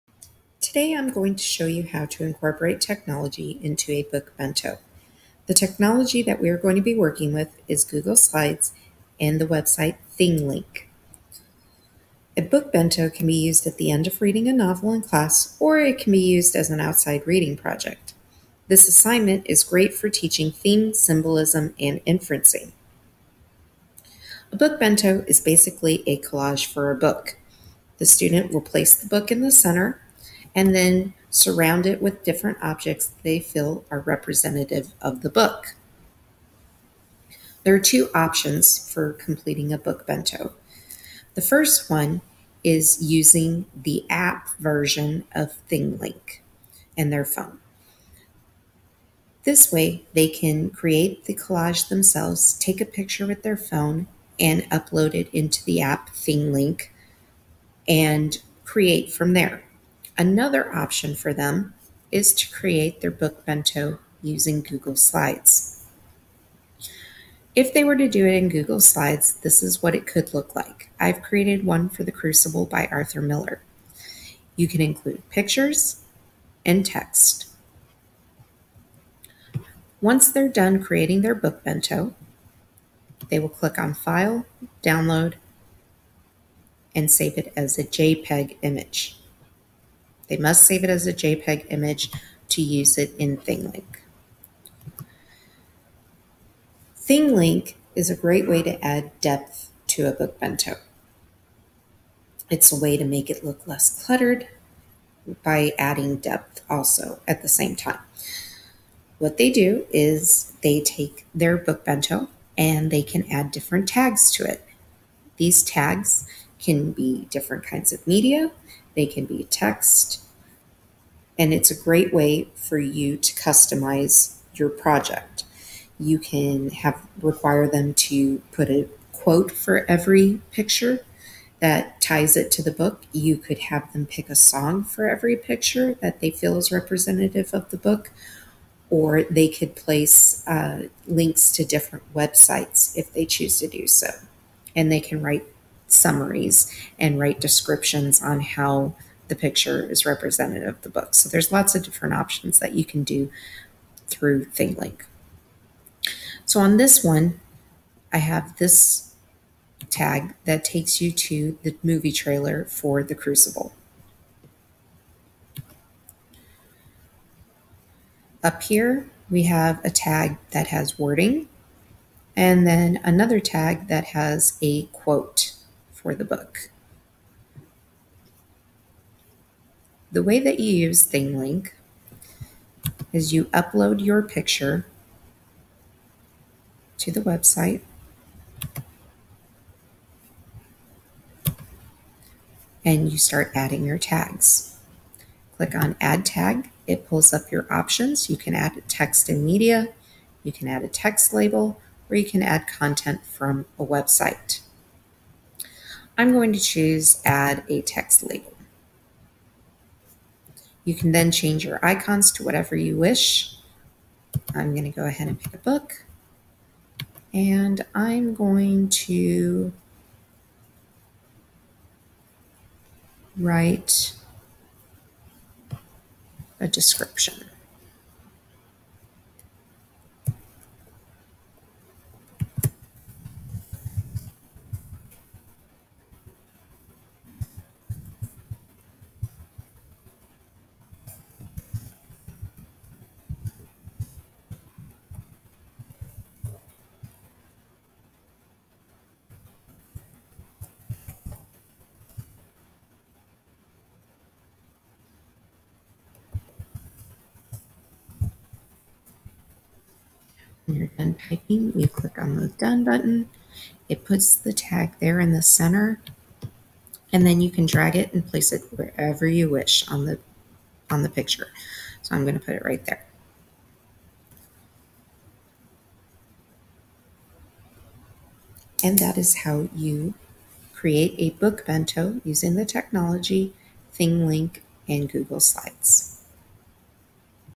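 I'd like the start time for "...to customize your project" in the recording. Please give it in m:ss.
2:03.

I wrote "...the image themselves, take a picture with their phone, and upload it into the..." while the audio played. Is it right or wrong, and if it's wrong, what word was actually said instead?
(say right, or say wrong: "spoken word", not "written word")
wrong: "collage", not "image".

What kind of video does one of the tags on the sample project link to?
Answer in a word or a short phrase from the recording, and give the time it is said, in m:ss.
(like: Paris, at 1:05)
movie trailer, at 2:41.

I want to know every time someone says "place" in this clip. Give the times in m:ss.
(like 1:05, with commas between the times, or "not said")
0:28, 2:19, 4:28.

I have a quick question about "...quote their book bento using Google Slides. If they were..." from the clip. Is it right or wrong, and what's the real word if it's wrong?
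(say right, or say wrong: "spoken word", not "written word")
wrong: "create", not "quote".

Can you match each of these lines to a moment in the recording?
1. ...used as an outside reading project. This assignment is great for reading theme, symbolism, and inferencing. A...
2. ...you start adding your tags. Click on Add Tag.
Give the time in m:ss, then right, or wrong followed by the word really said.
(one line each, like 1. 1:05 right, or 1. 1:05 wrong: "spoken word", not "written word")
1. 0:16 wrong: "teaching", not "reading"
2. 3:13 right.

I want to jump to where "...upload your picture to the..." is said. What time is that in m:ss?
3:03.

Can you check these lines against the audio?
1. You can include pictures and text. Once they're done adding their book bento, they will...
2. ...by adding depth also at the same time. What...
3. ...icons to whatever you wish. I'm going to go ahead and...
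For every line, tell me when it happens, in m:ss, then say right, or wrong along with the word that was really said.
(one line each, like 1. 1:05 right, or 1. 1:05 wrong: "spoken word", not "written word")
1. 1:14 wrong: "creating", not "adding"
2. 1:45 right
3. 3:31 right.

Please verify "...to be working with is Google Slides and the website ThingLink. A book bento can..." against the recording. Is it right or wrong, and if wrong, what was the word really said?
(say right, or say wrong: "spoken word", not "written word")
right.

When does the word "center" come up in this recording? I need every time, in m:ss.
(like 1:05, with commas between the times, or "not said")
0:29, 4:25.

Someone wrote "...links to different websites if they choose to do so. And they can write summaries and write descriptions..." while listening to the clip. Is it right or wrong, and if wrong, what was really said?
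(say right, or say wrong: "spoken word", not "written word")
right.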